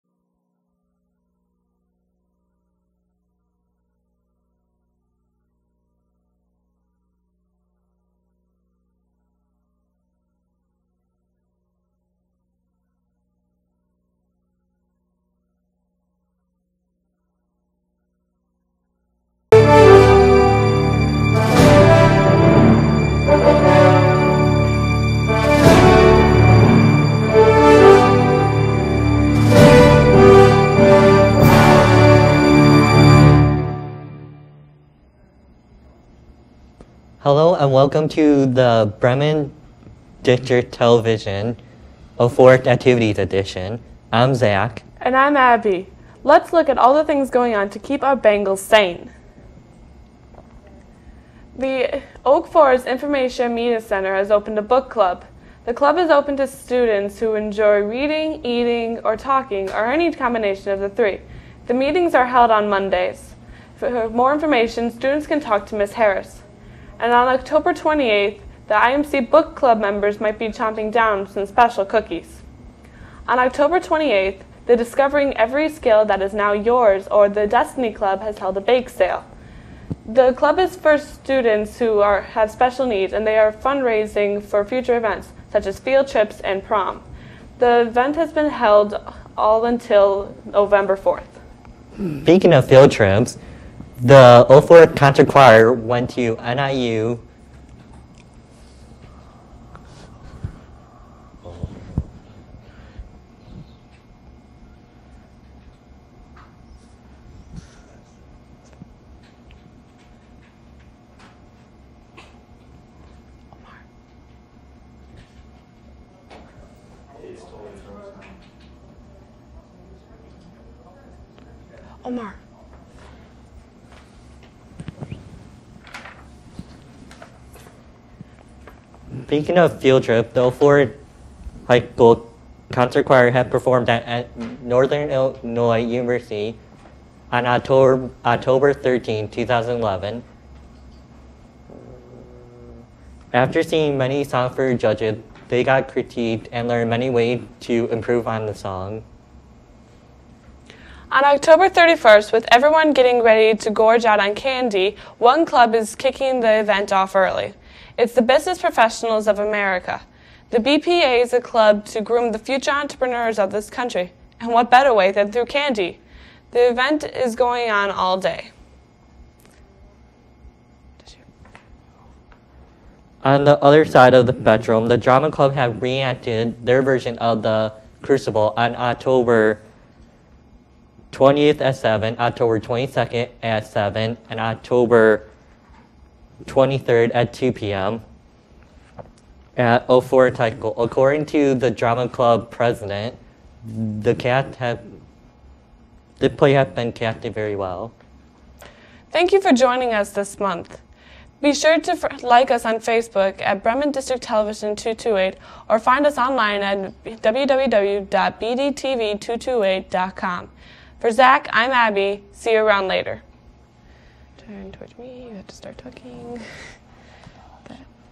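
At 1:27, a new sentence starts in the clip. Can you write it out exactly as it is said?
The event has been held all until November 4th.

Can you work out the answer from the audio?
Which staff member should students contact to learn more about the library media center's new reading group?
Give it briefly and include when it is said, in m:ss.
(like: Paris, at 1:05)
Ms. Harris, at 1:05.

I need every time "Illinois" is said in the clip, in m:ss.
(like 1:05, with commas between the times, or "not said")
2:15.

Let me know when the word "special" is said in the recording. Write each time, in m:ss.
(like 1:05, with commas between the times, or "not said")
1:11, 1:22.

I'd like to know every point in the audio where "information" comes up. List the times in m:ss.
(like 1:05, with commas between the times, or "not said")
0:52, 1:04.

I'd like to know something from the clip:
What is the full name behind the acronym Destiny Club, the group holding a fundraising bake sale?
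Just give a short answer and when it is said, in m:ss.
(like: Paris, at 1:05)
Discovering Every Skill That Is Now Yours, at 1:14.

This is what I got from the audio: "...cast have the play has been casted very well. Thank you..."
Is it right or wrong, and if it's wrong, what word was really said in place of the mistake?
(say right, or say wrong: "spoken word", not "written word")
right.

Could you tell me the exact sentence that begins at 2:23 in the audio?
After seeing many songs for judges, they got critiqued and learned many ways to improve on the song.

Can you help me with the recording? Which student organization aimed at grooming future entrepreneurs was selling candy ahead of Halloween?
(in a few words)
Business Professionals of America.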